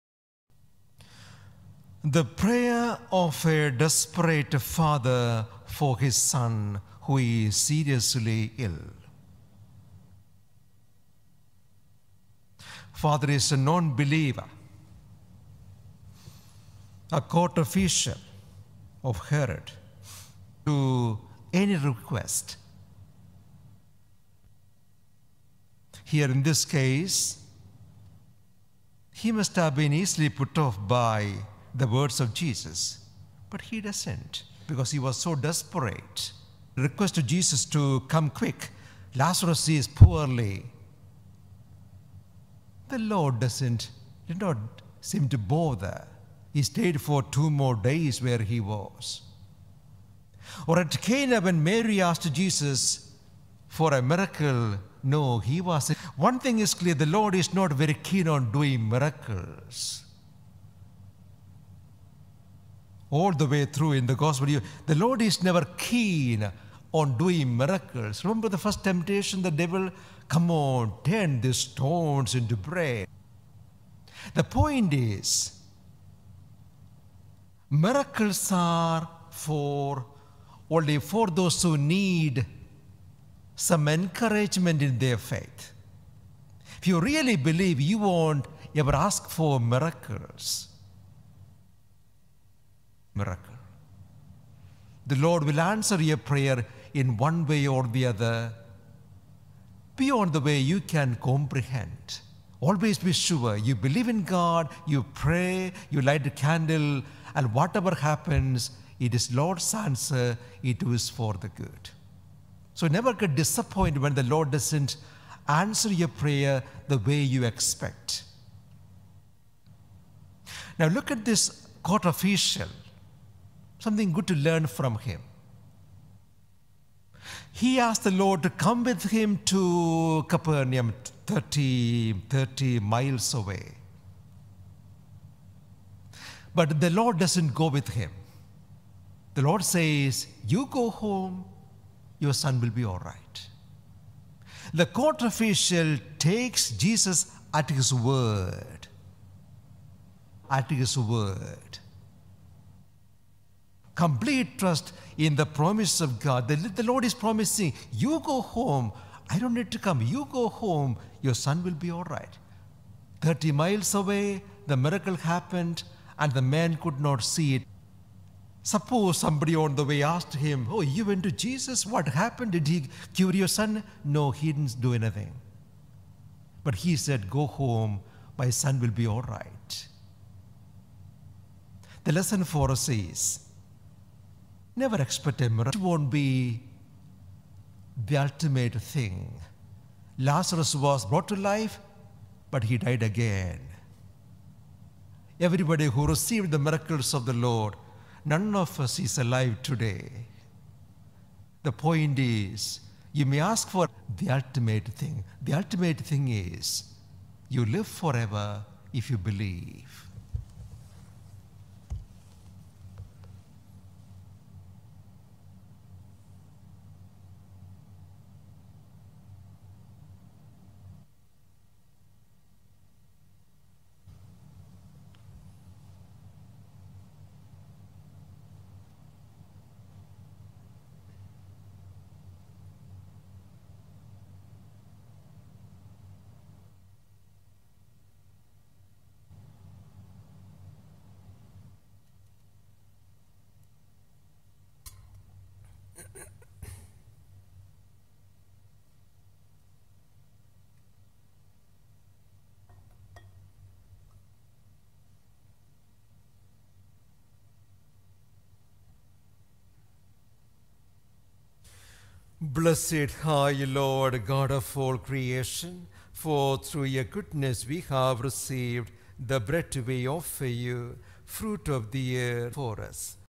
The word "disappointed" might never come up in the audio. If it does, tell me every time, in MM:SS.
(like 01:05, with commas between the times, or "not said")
01:53.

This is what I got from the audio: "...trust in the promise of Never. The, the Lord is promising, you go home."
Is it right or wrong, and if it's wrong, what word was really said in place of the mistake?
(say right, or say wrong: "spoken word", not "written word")
wrong: "God", not "Never".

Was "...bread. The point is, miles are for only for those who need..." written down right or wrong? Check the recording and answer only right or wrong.
wrong.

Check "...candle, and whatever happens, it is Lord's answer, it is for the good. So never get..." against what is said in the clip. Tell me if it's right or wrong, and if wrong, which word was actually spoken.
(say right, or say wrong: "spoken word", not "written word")
right.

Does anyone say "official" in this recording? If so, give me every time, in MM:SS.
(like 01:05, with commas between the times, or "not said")
00:17, 02:02, 02:25.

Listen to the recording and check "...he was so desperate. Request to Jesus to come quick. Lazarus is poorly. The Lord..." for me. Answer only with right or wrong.
right.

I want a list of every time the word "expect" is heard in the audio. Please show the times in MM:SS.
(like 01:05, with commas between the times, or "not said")
01:57, 03:05.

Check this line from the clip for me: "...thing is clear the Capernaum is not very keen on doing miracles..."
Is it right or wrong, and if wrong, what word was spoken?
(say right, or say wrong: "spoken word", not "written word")
wrong: "Lord", not "Capernaum".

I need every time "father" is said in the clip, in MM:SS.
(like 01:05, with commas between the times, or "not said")
00:04, 00:12.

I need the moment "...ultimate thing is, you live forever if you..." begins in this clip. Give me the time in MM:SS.
03:25.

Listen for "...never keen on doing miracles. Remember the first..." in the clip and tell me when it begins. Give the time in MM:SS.
01:05.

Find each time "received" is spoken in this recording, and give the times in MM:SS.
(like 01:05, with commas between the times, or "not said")
03:16, 04:28.